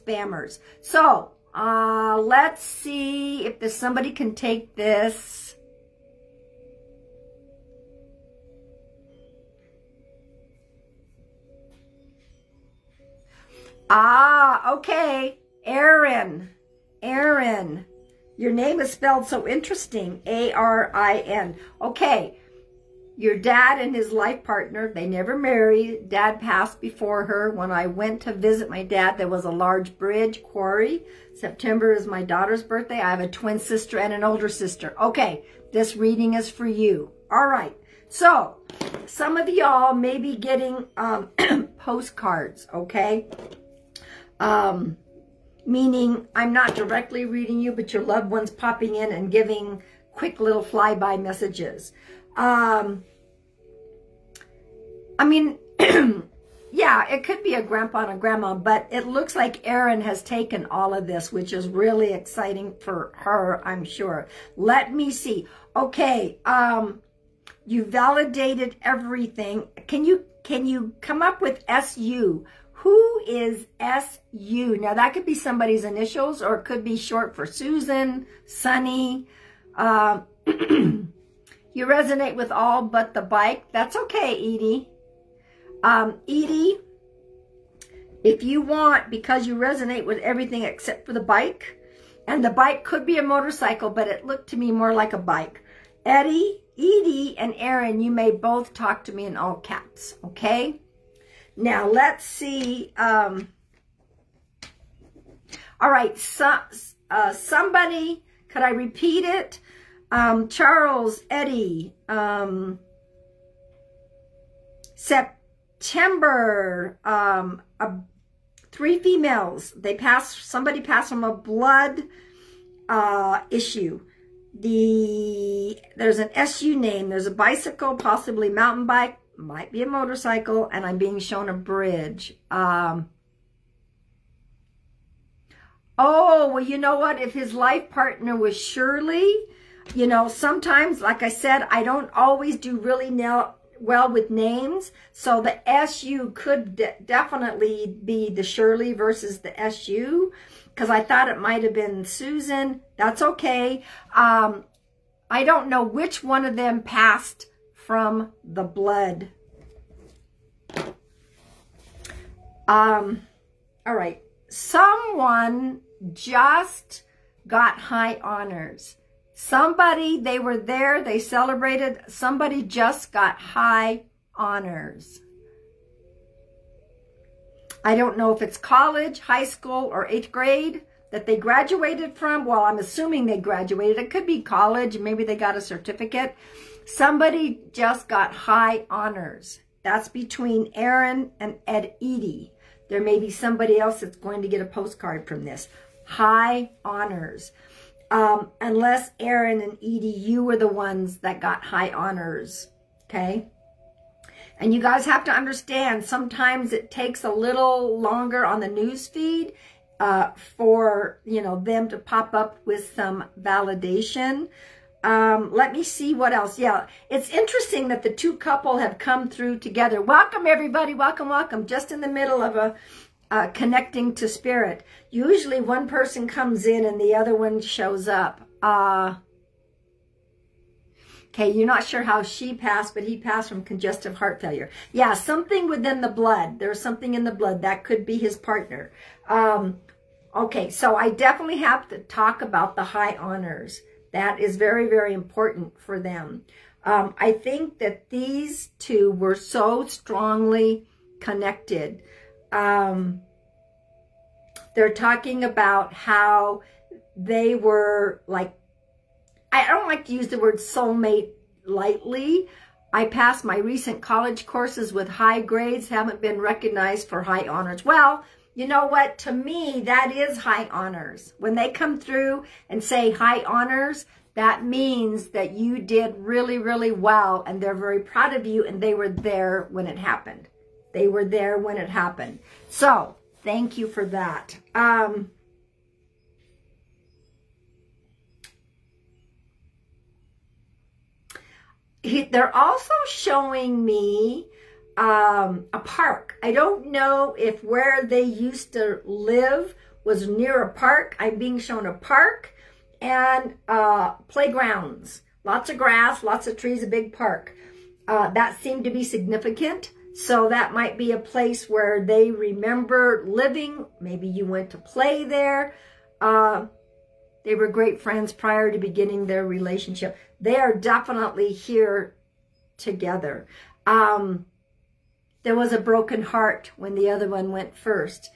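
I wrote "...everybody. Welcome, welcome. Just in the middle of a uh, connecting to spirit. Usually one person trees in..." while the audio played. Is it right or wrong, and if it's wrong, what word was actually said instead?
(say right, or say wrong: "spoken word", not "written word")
wrong: "comes", not "trees".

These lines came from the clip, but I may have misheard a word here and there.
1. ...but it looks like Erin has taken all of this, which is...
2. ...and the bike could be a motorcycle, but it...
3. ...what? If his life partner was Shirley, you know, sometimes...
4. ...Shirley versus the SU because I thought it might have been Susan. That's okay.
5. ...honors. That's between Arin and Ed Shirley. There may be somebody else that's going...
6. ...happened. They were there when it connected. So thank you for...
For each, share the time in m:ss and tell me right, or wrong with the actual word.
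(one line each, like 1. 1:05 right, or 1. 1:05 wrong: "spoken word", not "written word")
1. 0:58 right
2. 1:32 right
3. 2:16 right
4. 2:28 right
5. 3:08 wrong: "Edie", not "Shirley"
6. 4:39 wrong: "happened", not "connected".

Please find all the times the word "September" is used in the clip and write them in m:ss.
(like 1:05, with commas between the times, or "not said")
0:31, 1:54.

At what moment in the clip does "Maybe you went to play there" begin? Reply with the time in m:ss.
5:14.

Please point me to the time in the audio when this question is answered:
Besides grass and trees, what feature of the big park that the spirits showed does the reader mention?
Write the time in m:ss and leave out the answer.
5:04.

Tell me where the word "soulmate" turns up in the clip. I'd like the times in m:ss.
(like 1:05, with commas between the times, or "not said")
4:20.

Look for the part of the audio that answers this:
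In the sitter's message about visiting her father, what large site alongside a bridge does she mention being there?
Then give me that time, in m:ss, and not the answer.
0:30.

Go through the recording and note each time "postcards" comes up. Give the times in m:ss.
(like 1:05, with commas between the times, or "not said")
0:41, 3:14.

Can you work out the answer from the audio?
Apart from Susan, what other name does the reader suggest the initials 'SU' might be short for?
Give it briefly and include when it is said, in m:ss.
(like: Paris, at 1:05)
Sunny, at 1:18.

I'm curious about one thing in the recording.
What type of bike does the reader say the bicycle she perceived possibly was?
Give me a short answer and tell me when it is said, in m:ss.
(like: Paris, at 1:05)
mountain bike, at 2:08.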